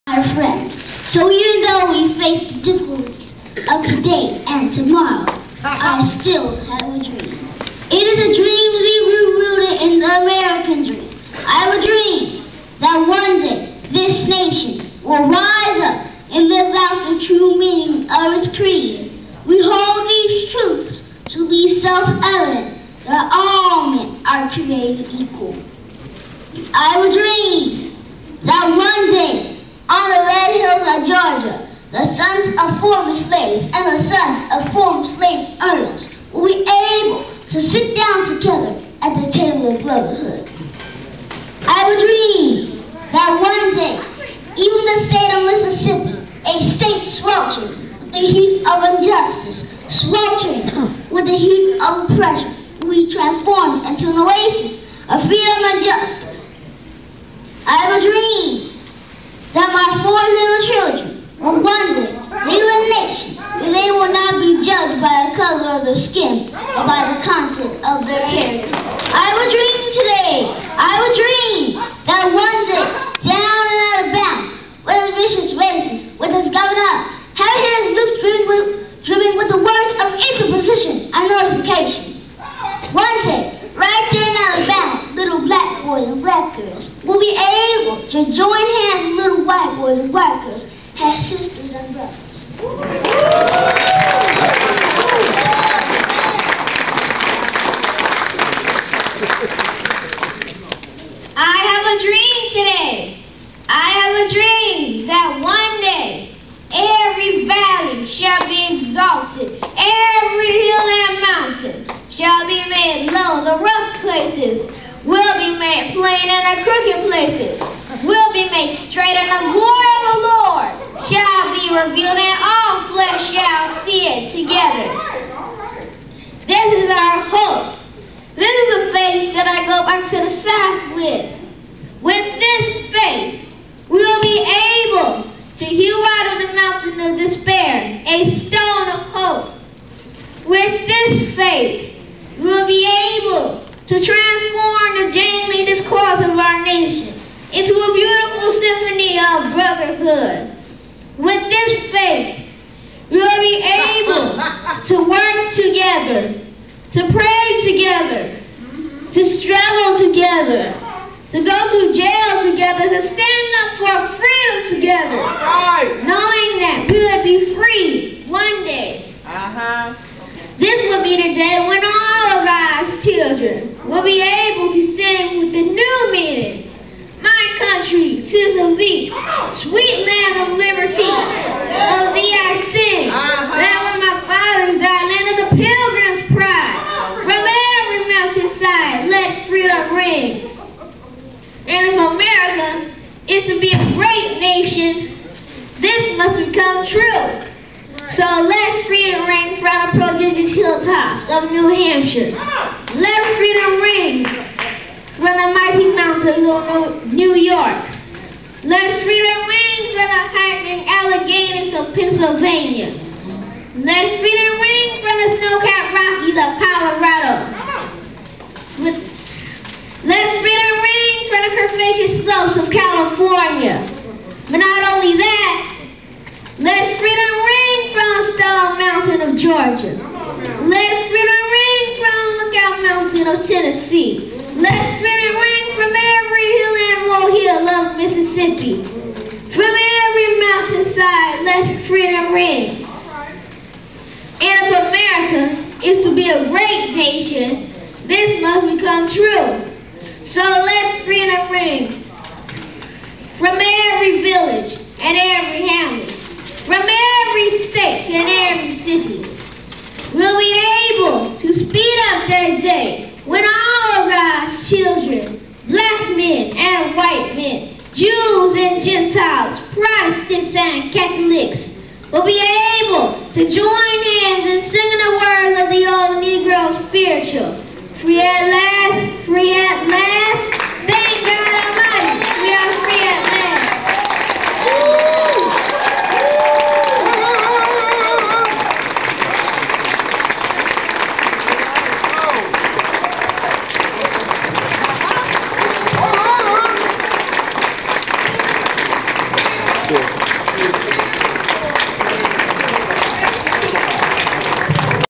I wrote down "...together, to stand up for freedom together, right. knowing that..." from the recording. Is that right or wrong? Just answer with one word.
right.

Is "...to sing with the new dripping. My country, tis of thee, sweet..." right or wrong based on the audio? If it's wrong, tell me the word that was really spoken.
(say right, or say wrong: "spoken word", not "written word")
wrong: "meaning", not "dripping".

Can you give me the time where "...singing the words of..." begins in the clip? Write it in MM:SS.
04:34.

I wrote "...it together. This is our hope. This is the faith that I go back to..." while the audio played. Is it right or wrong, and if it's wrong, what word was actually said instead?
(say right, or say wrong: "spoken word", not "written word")
right.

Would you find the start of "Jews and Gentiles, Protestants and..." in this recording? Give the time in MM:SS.
04:28.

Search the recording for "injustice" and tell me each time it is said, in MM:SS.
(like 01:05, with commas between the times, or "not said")
00:48.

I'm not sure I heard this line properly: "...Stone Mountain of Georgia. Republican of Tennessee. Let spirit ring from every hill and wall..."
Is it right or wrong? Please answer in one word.
right.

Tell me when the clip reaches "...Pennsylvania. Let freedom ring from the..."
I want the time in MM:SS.
03:31.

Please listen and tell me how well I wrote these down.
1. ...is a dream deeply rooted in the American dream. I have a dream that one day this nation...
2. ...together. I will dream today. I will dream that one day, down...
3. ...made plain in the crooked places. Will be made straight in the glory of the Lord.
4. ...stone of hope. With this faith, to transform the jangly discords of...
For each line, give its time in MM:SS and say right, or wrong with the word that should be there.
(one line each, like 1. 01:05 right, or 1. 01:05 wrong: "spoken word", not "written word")
1. 00:08 right
2. 01:08 wrong: "character", not "together"
3. 01:55 right
4. 02:18 right.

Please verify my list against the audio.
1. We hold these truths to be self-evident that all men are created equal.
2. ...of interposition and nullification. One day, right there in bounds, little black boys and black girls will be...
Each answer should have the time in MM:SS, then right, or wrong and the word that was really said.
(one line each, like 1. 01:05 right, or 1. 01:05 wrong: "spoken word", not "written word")
1. 00:19 right
2. 01:19 right.